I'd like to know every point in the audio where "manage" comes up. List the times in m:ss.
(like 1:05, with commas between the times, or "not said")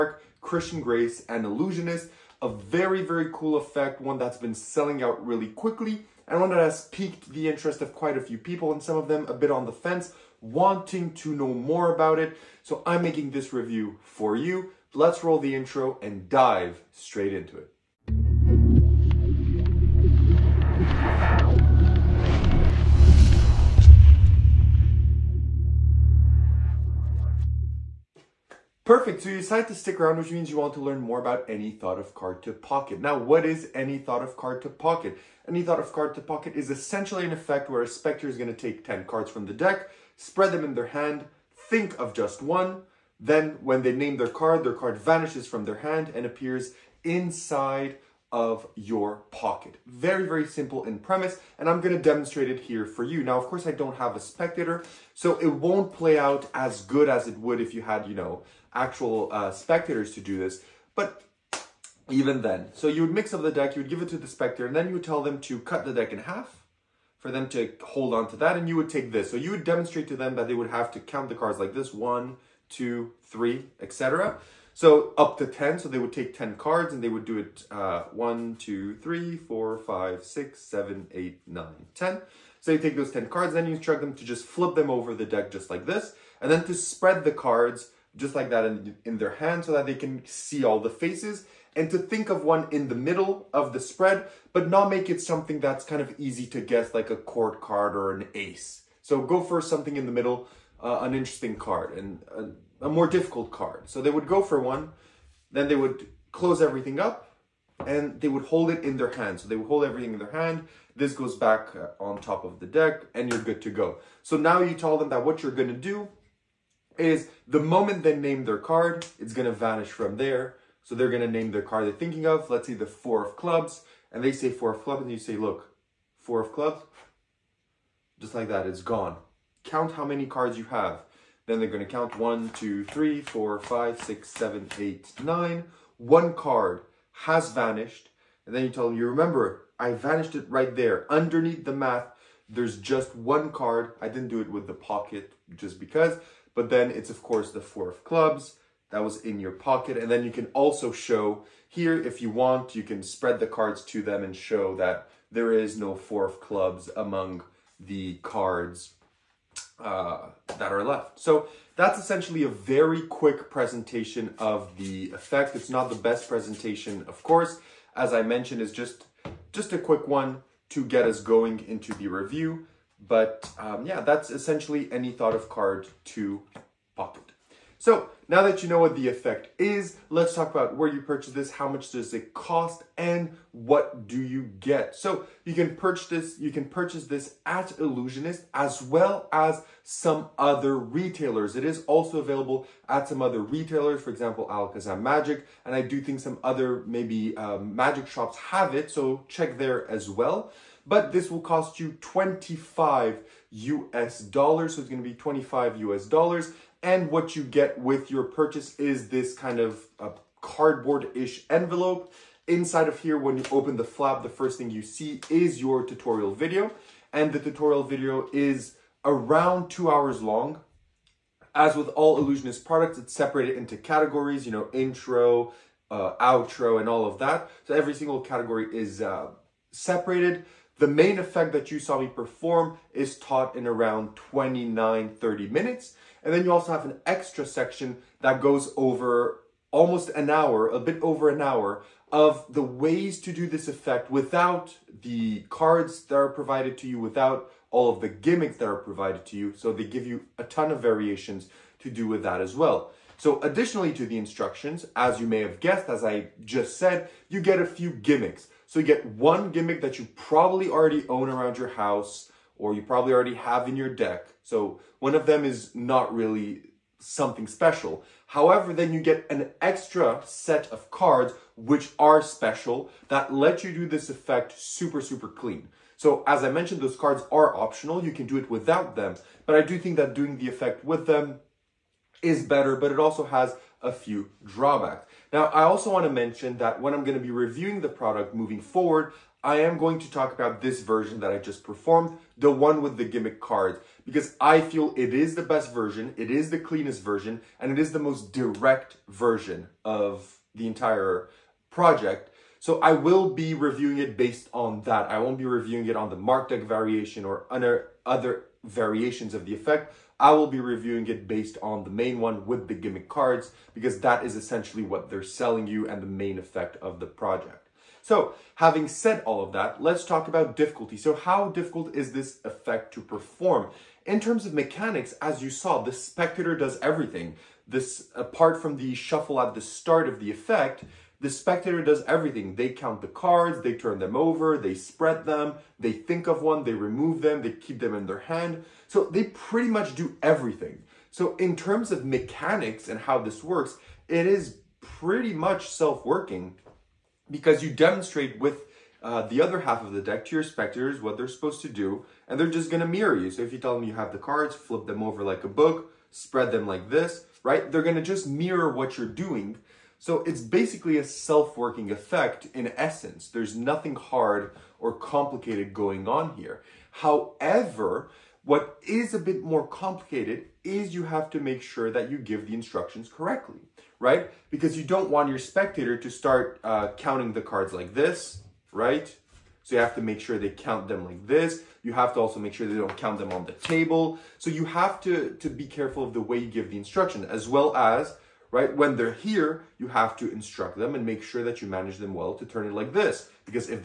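6:31.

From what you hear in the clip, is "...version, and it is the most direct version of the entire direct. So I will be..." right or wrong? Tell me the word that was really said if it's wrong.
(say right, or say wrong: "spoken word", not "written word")
wrong: "project", not "direct".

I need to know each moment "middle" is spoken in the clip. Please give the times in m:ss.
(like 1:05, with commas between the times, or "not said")
1:32, 1:40.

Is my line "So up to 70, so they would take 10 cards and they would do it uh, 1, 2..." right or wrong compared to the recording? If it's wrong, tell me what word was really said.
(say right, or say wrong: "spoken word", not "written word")
wrong: "10", not "70".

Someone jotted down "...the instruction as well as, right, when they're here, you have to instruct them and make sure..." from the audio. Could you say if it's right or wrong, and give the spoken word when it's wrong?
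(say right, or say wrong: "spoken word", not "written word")
right.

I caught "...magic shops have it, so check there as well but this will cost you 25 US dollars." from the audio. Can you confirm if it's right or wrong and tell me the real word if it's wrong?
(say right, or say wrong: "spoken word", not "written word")
right.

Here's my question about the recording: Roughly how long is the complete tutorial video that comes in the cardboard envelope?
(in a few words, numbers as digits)
two hours.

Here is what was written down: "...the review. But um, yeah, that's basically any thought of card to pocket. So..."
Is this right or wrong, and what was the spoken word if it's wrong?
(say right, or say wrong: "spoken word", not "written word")
wrong: "essentially", not "basically".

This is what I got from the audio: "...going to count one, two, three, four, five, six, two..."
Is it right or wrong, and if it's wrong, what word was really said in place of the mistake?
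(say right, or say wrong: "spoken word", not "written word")
wrong: "seven", not "two".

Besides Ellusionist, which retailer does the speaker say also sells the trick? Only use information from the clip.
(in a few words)
Alakazam Magic.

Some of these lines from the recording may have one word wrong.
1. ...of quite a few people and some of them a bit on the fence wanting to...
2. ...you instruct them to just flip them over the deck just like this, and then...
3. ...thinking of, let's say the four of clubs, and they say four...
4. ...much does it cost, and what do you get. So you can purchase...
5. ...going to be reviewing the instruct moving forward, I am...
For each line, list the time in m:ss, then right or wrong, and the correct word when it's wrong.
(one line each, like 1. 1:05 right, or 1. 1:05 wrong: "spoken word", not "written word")
1. 0:07 right
2. 1:23 right
3. 2:01 right
4. 3:01 right
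5. 4:47 wrong: "product", not "instruct".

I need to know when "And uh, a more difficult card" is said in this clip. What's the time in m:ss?
1:41.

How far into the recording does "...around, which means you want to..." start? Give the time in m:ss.
0:29.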